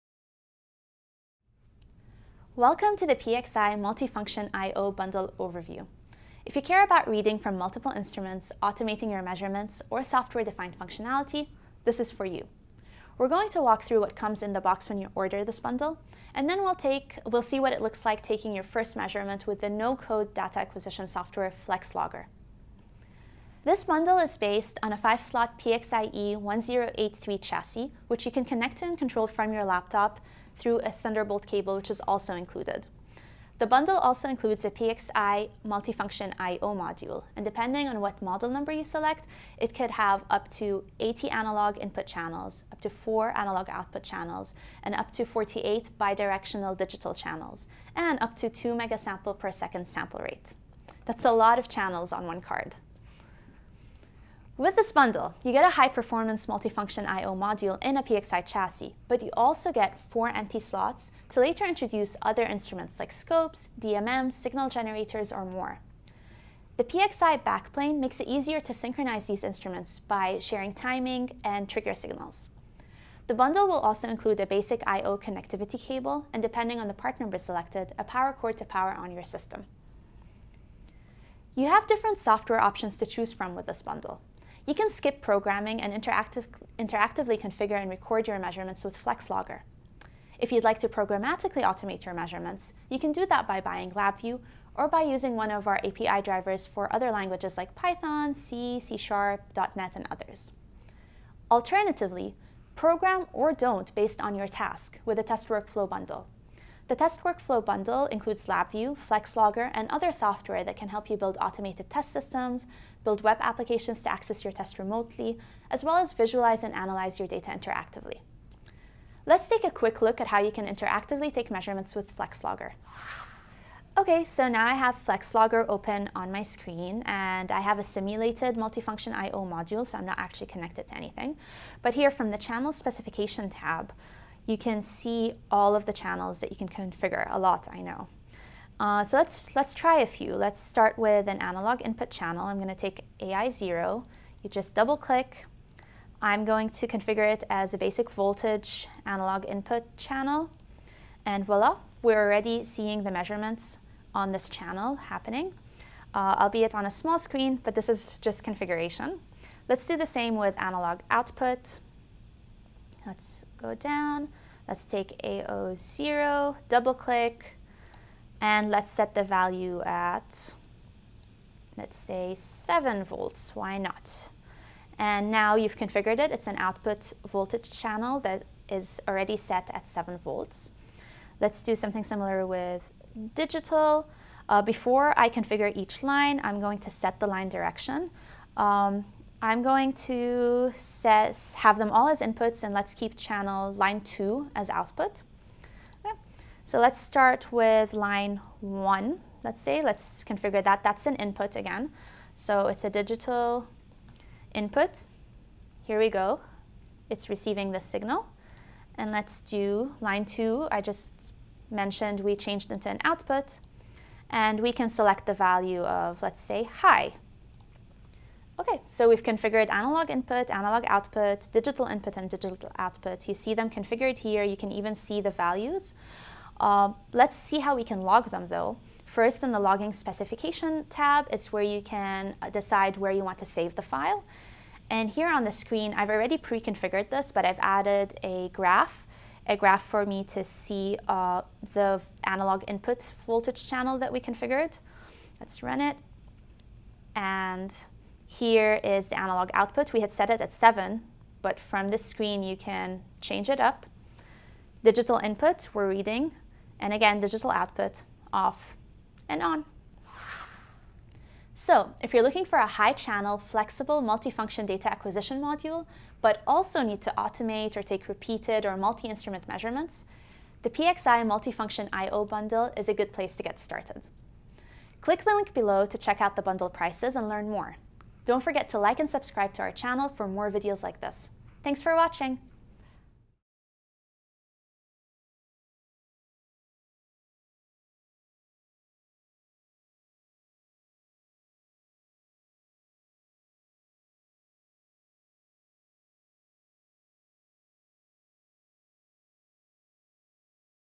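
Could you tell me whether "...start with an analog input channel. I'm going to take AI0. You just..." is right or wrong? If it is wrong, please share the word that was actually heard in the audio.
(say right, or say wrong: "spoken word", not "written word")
right.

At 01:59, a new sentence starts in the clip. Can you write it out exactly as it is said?
Let's take a quick look at how you can interactively take measurements with FlexLogger.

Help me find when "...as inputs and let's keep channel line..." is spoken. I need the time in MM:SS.
03:12.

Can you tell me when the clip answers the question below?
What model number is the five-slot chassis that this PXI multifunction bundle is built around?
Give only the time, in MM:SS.
00:25.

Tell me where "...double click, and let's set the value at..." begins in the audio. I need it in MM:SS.
02:46.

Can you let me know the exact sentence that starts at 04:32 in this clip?
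bundle is a good place to get started.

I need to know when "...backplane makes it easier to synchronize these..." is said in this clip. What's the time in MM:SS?
01:07.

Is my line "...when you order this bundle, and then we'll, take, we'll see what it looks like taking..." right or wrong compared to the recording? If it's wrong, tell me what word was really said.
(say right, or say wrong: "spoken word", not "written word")
right.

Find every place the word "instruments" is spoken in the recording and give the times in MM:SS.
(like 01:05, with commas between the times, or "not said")
00:07, 01:02, 01:09, 04:28.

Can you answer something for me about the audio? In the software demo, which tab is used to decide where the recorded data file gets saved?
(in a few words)
logging specification tab.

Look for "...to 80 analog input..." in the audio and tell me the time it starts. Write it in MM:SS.
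00:40.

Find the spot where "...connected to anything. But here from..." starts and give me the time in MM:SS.
02:10.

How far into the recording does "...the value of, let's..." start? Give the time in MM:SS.
03:35.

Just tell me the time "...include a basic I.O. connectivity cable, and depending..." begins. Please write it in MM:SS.
01:14.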